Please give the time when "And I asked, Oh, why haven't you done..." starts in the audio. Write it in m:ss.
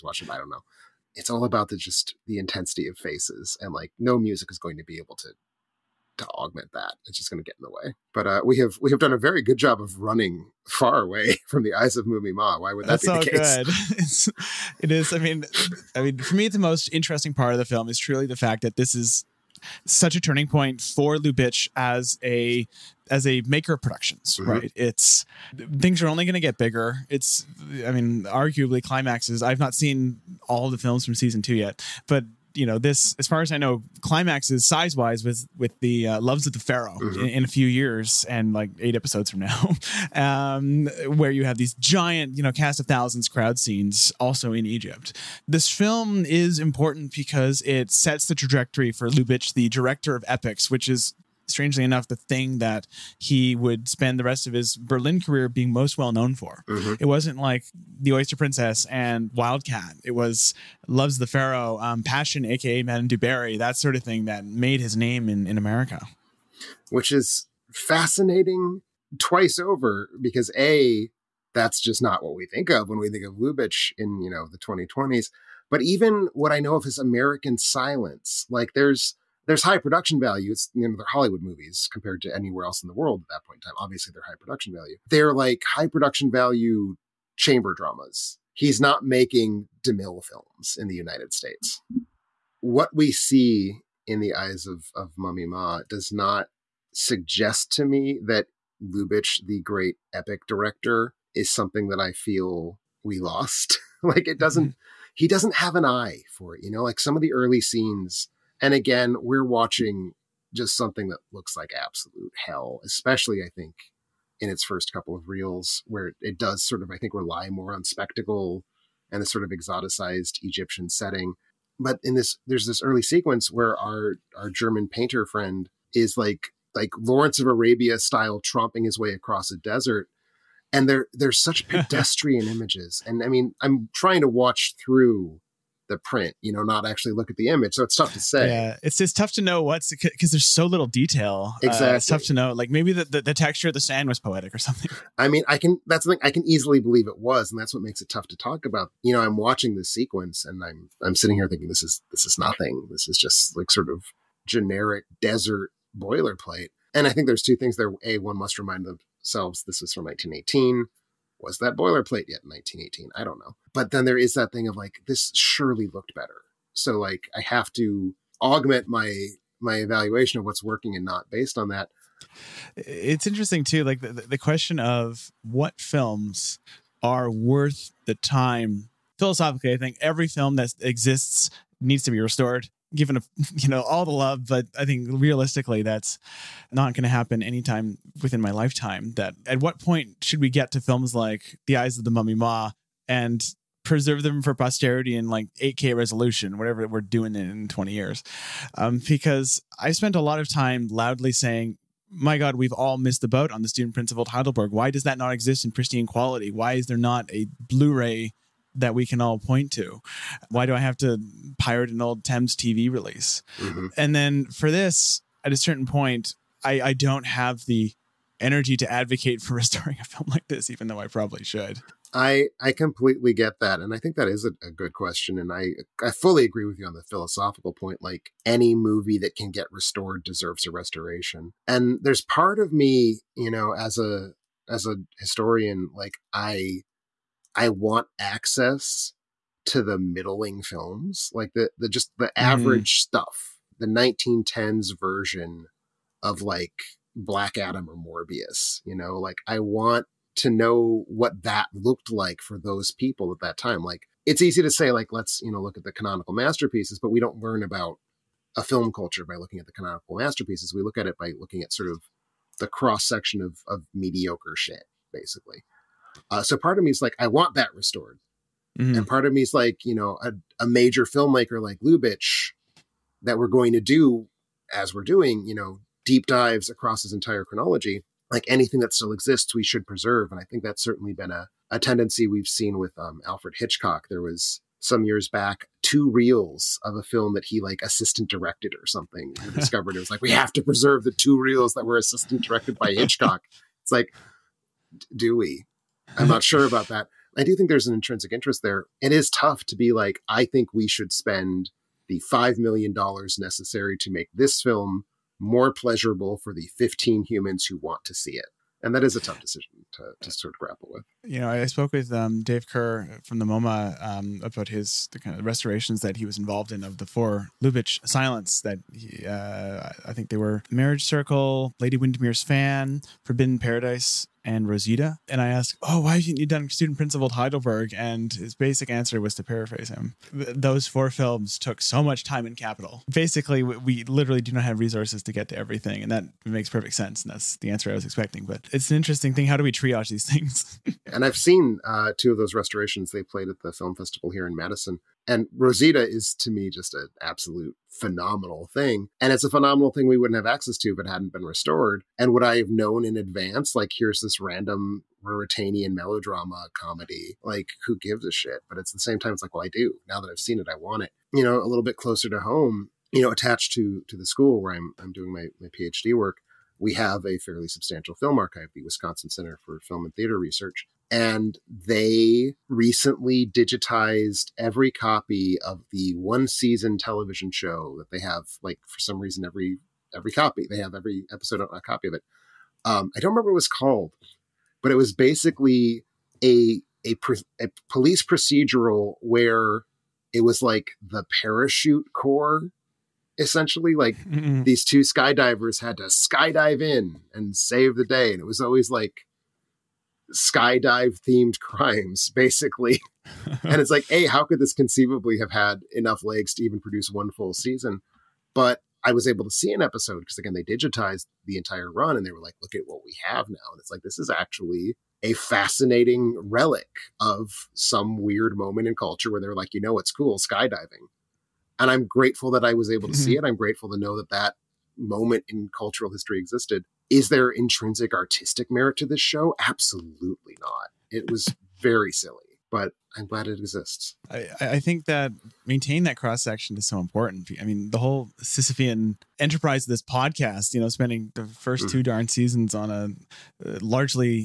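5:25.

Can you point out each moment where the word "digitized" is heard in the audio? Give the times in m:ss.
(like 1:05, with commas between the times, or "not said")
6:13, 6:50.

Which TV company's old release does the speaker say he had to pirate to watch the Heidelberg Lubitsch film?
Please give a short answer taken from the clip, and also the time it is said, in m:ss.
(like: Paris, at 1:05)
Thames TV, at 3:32.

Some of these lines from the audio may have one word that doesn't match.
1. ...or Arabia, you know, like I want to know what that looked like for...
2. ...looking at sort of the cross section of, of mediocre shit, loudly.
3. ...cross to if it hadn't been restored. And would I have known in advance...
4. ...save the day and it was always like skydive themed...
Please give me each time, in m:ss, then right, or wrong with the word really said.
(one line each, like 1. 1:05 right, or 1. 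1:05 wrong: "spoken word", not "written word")
1. 4:07 wrong: "Morbius", not "Arabia"
2. 4:21 wrong: "basically", not "loudly"
3. 5:50 wrong: "access", not "cross"
4. 6:37 right.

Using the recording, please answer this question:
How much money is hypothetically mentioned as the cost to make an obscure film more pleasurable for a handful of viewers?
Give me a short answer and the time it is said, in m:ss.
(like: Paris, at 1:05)
$5 million, at 5:02.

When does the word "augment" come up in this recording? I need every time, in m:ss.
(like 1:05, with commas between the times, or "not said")
0:06, 2:48.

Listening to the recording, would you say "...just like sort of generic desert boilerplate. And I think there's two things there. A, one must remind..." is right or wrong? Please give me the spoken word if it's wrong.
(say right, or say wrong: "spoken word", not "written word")
right.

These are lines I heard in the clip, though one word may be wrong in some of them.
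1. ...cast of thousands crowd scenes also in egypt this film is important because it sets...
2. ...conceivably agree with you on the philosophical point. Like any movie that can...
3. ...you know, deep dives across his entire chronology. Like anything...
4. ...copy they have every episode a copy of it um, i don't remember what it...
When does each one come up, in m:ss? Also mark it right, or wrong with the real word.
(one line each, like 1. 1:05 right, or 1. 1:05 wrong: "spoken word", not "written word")
1. 0:42 right
2. 3:46 wrong: "fully", not "conceivably"
3. 4:35 right
4. 6:20 right.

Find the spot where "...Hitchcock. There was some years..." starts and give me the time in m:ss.
4:43.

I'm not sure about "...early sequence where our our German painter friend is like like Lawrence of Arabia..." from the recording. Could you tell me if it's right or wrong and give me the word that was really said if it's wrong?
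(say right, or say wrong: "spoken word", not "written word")
right.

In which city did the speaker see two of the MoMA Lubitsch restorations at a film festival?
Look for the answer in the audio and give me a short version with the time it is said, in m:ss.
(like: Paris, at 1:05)
Madison, at 5:44.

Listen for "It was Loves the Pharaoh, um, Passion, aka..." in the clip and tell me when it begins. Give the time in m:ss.
1:00.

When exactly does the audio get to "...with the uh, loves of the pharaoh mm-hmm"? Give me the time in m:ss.
0:35.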